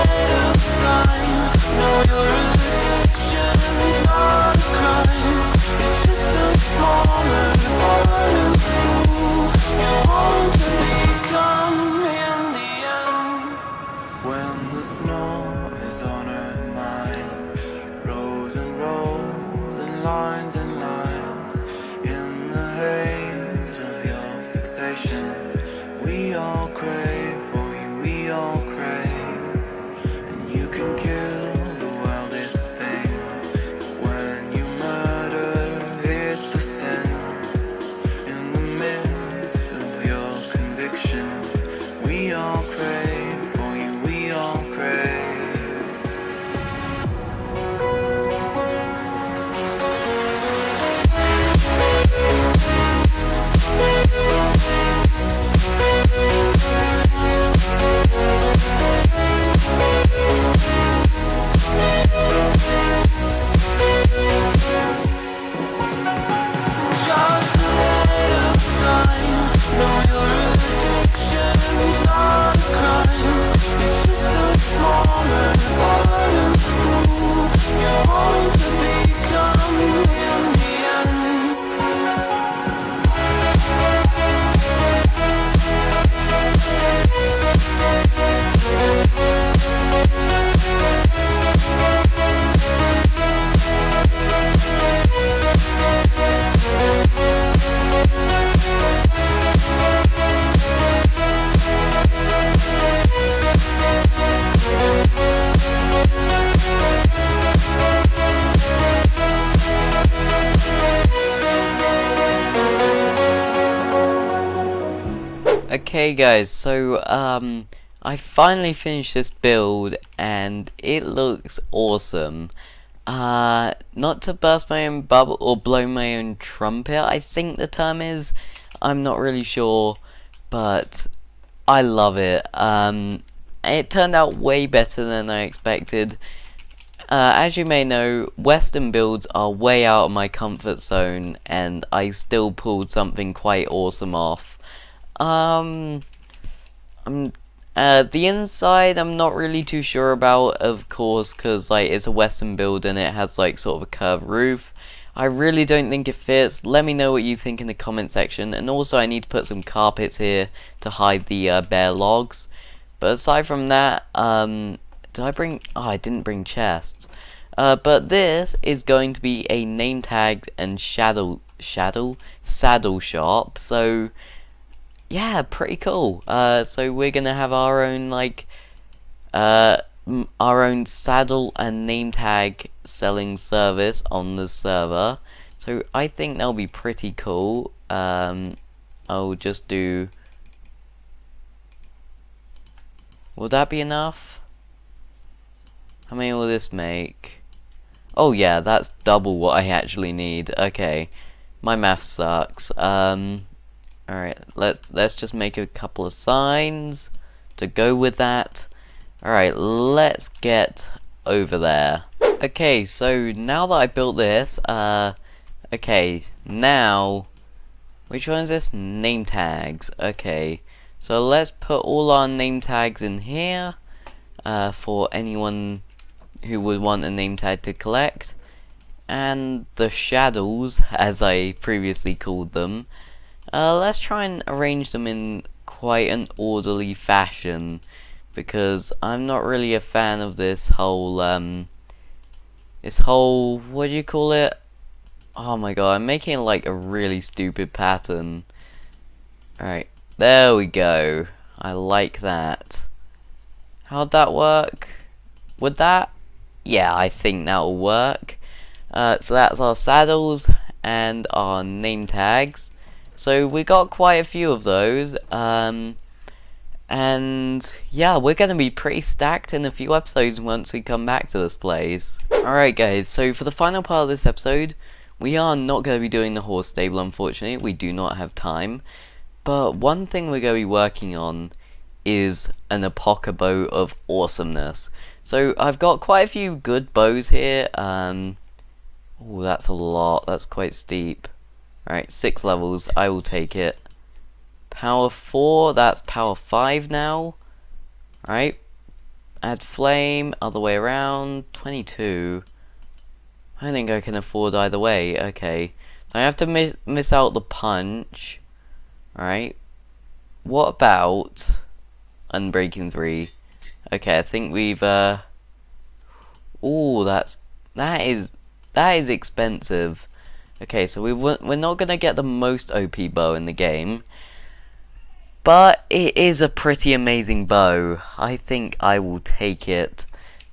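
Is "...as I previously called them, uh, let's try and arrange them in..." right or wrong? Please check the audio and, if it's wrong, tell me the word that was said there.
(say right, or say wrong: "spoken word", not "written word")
right.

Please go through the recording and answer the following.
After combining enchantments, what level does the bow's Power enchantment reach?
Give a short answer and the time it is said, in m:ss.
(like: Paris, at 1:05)
Power 5, at 4:56.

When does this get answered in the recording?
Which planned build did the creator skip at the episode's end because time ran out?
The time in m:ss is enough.
4:36.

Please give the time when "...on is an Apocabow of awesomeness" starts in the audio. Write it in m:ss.
4:41.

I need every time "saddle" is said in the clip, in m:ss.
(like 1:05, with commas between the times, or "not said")
2:52, 3:00, 4:19.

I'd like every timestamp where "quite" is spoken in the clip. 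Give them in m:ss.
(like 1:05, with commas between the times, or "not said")
2:23, 3:55, 4:23, 4:45, 4:50.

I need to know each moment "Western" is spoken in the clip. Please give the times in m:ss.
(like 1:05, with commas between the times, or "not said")
2:18, 2:32.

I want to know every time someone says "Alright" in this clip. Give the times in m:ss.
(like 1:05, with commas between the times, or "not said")
3:24, 3:29, 4:09, 4:32, 4:51, 4:58, 5:09.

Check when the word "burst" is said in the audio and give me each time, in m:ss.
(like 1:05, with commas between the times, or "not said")
2:04.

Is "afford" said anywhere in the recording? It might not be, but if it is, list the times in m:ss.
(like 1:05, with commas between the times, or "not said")
5:04.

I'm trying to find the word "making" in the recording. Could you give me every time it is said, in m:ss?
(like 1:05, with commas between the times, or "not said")
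4:06.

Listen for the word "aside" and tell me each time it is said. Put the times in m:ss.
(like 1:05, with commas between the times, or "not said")
2:43.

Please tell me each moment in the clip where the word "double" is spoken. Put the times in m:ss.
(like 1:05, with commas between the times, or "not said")
3:18.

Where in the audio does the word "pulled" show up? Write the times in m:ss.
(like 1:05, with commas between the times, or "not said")
2:22.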